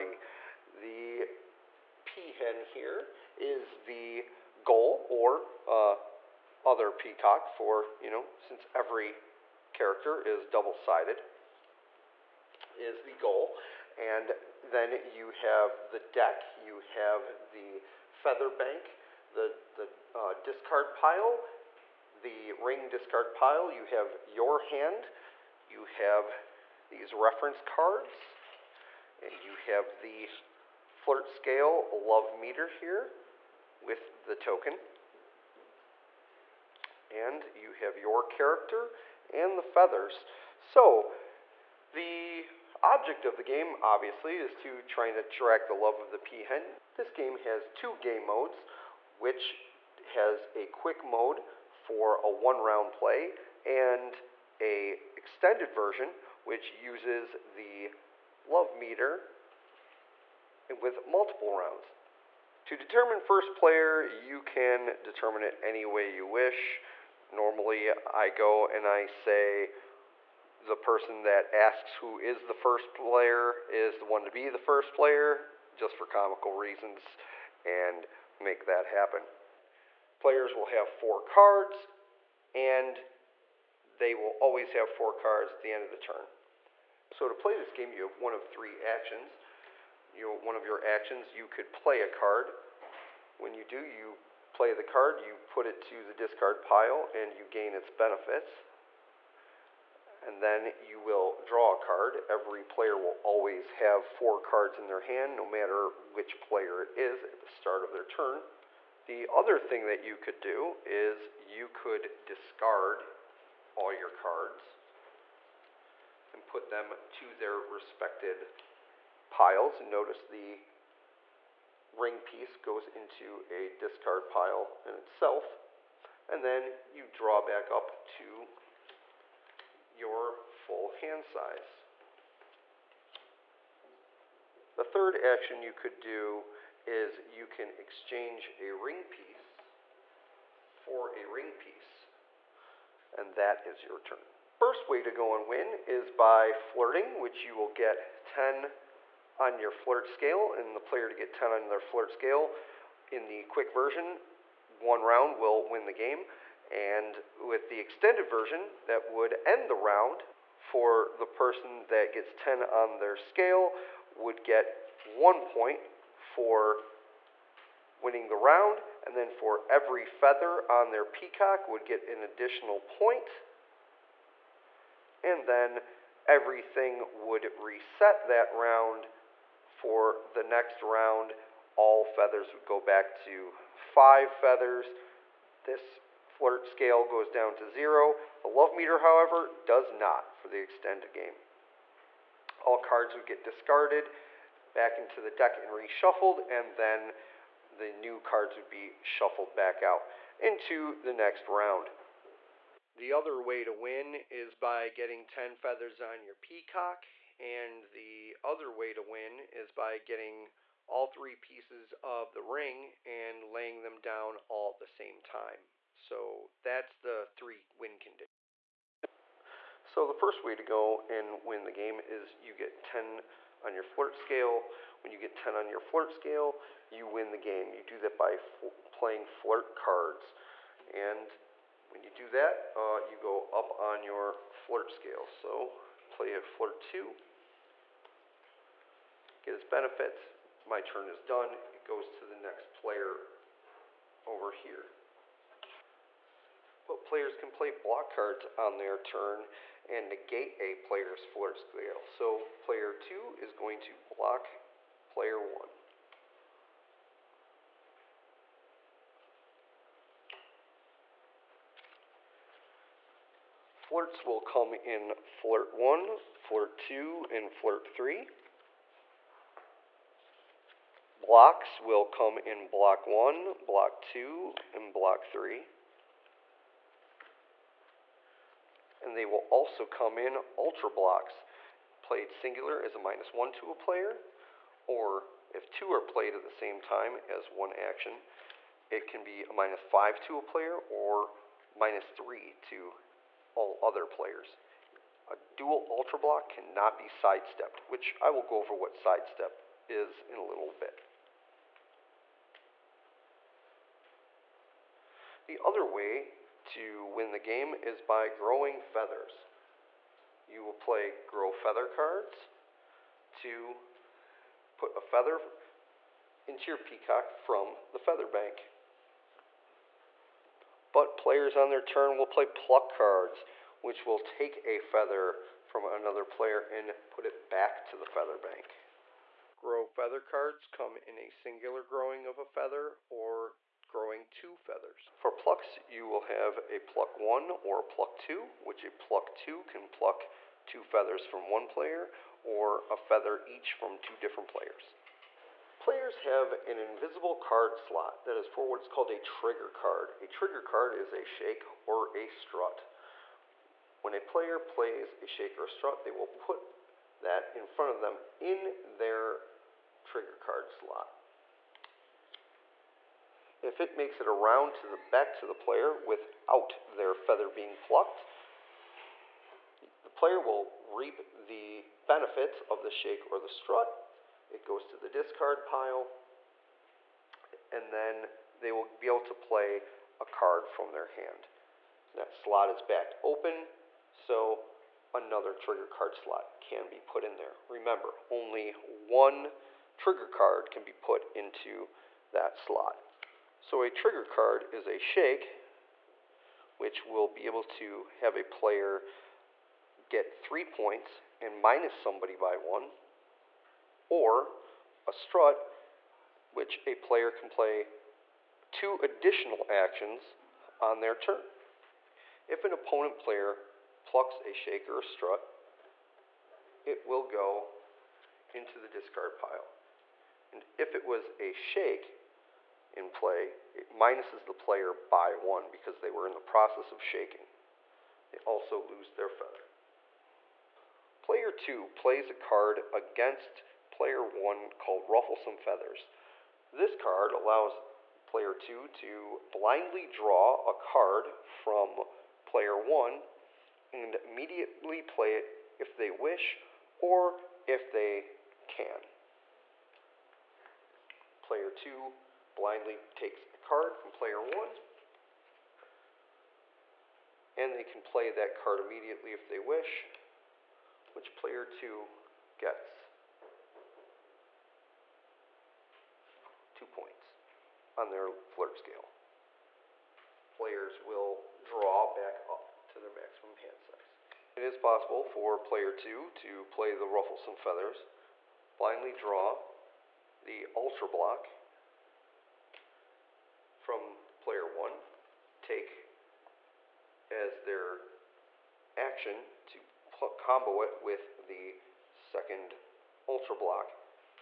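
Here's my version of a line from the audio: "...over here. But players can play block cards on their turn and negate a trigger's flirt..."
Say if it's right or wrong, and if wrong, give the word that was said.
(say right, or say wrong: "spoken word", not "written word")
wrong: "player", not "trigger".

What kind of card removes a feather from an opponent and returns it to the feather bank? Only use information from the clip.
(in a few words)
pluck cards.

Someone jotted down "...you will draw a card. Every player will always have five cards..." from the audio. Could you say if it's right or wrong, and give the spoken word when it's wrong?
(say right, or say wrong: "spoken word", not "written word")
wrong: "four", not "five".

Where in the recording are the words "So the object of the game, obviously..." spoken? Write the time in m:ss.
0:40.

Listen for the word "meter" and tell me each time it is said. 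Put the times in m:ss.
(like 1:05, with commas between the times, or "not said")
0:32, 0:58, 3:08.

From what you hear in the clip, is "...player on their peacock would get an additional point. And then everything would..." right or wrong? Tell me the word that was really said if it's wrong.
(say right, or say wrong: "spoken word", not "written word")
wrong: "feather", not "player".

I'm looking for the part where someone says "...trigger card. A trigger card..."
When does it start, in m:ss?
5:49.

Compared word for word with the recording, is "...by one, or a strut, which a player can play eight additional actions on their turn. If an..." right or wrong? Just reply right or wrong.
wrong.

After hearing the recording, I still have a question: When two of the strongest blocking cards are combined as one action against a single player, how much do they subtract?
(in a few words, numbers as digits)
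minus five.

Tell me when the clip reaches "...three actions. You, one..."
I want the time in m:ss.
1:28.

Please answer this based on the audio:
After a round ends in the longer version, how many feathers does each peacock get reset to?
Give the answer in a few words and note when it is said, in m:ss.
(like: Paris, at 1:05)
5, at 3:03.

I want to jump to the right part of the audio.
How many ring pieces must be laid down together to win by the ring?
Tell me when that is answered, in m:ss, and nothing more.
3:30.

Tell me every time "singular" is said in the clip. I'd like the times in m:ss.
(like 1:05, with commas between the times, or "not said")
4:42, 5:31.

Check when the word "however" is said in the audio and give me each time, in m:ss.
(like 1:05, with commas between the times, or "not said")
3:08.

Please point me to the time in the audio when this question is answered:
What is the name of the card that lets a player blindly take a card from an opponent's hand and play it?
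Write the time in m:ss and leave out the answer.
7:15.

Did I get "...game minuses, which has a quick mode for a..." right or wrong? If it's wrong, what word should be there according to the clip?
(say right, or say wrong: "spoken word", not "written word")
wrong: "modes", not "minuses".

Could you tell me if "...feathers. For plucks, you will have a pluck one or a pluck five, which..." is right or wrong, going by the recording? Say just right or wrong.
wrong.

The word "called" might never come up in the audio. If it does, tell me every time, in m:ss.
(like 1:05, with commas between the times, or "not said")
5:48, 7:14.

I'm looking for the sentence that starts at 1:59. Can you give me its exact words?
Notice the ring piece goes into a discard pile in itself, and then you draw back up to your full hand size.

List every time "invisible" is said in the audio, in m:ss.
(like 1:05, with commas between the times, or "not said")
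5:46.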